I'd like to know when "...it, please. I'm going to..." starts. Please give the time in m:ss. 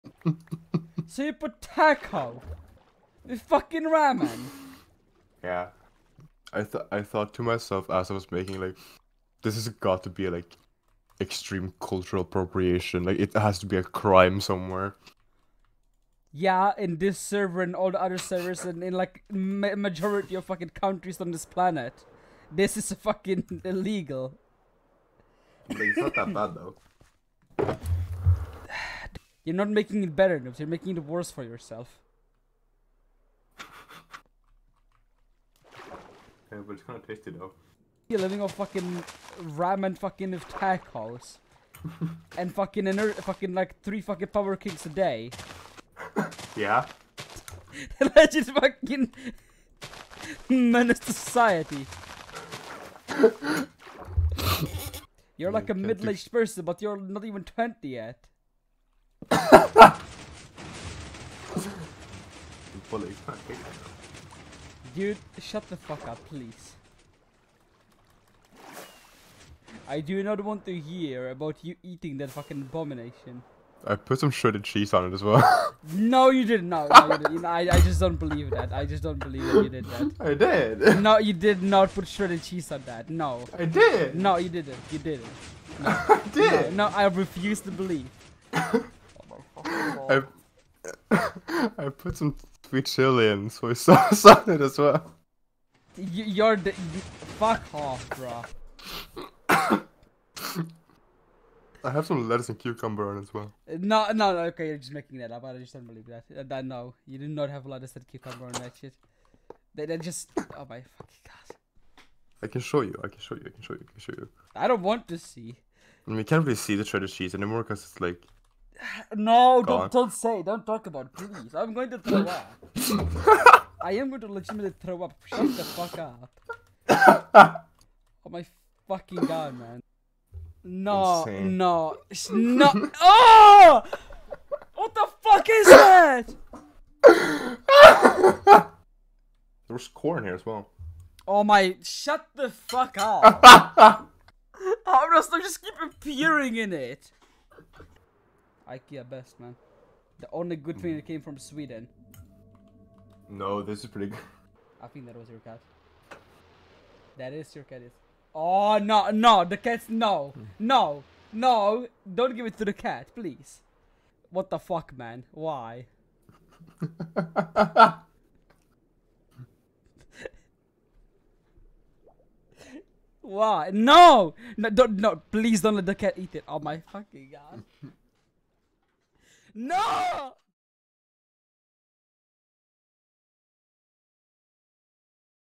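2:01.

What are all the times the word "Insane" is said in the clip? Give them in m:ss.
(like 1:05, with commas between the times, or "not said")
2:11.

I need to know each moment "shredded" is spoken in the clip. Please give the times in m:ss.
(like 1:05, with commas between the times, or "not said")
1:14, 1:22, 1:56.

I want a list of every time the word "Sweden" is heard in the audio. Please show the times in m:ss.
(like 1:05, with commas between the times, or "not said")
2:31.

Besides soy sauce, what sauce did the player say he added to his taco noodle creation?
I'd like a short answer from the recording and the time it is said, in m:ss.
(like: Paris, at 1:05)
Sweet chili, at 1:32.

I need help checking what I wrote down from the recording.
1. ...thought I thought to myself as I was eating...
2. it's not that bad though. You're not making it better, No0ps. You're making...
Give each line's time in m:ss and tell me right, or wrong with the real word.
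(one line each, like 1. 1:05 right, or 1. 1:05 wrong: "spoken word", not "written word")
1. 0:06 wrong: "making", not "eating"
2. 0:25 right.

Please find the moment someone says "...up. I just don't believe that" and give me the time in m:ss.
1:45.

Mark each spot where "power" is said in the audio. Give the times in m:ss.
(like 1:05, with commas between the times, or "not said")
0:44.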